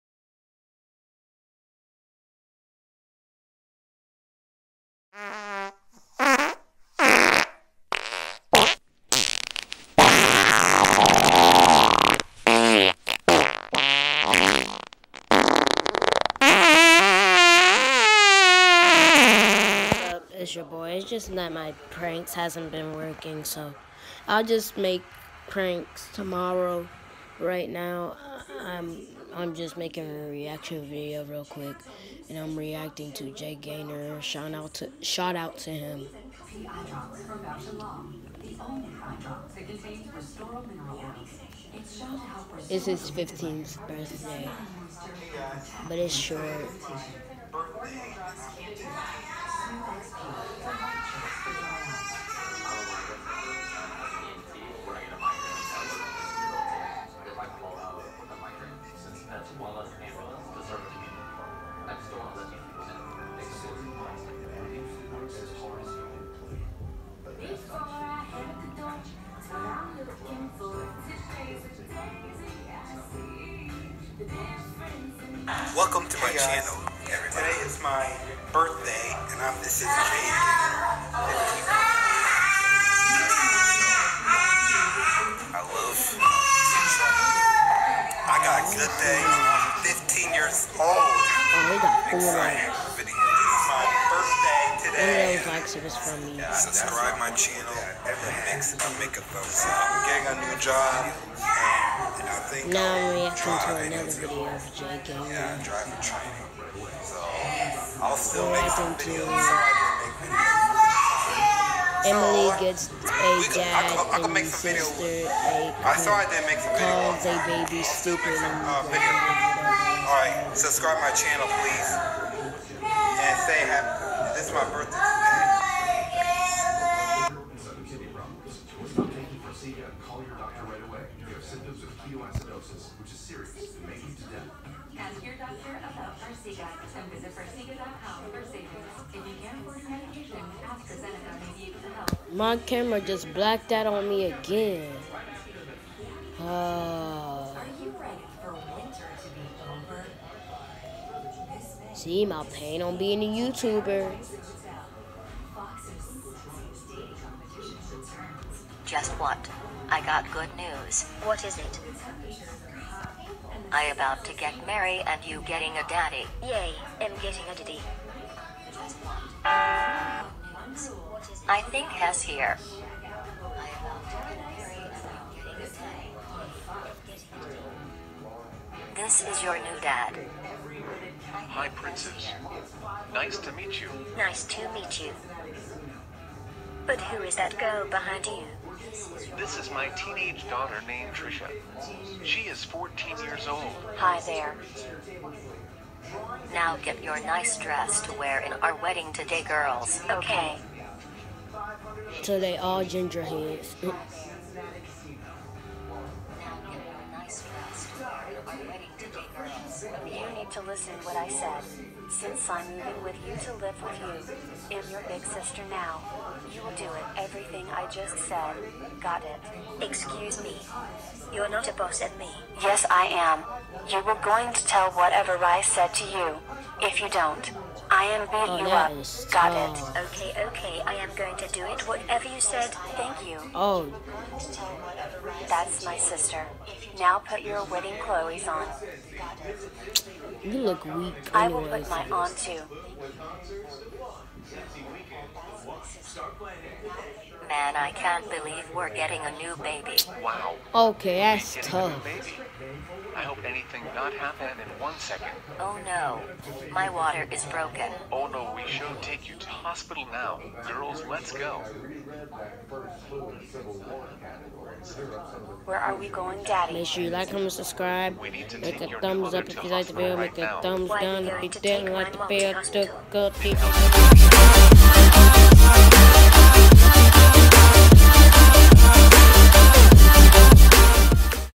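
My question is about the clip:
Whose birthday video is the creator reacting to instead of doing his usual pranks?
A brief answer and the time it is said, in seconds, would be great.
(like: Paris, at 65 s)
Jay Gaynor, at 33 s.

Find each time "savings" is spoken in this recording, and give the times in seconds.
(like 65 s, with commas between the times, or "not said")
137 s.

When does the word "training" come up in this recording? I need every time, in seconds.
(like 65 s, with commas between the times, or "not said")
105 s.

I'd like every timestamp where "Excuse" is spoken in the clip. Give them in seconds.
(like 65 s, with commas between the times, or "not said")
219 s.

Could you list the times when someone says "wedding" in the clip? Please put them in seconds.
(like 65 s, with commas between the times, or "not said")
198 s, 237 s.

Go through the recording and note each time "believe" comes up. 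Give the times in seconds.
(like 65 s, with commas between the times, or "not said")
248 s.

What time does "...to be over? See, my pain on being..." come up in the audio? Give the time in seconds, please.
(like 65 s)
149 s.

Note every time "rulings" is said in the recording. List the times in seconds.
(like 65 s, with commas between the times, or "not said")
not said.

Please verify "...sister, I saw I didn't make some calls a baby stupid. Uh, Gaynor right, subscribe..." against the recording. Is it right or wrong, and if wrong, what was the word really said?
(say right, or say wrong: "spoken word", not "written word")
wrong: "All", not "Gaynor".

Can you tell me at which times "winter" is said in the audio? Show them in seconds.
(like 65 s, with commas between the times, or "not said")
148 s.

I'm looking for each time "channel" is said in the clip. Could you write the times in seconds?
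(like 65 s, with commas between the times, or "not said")
97 s, 121 s.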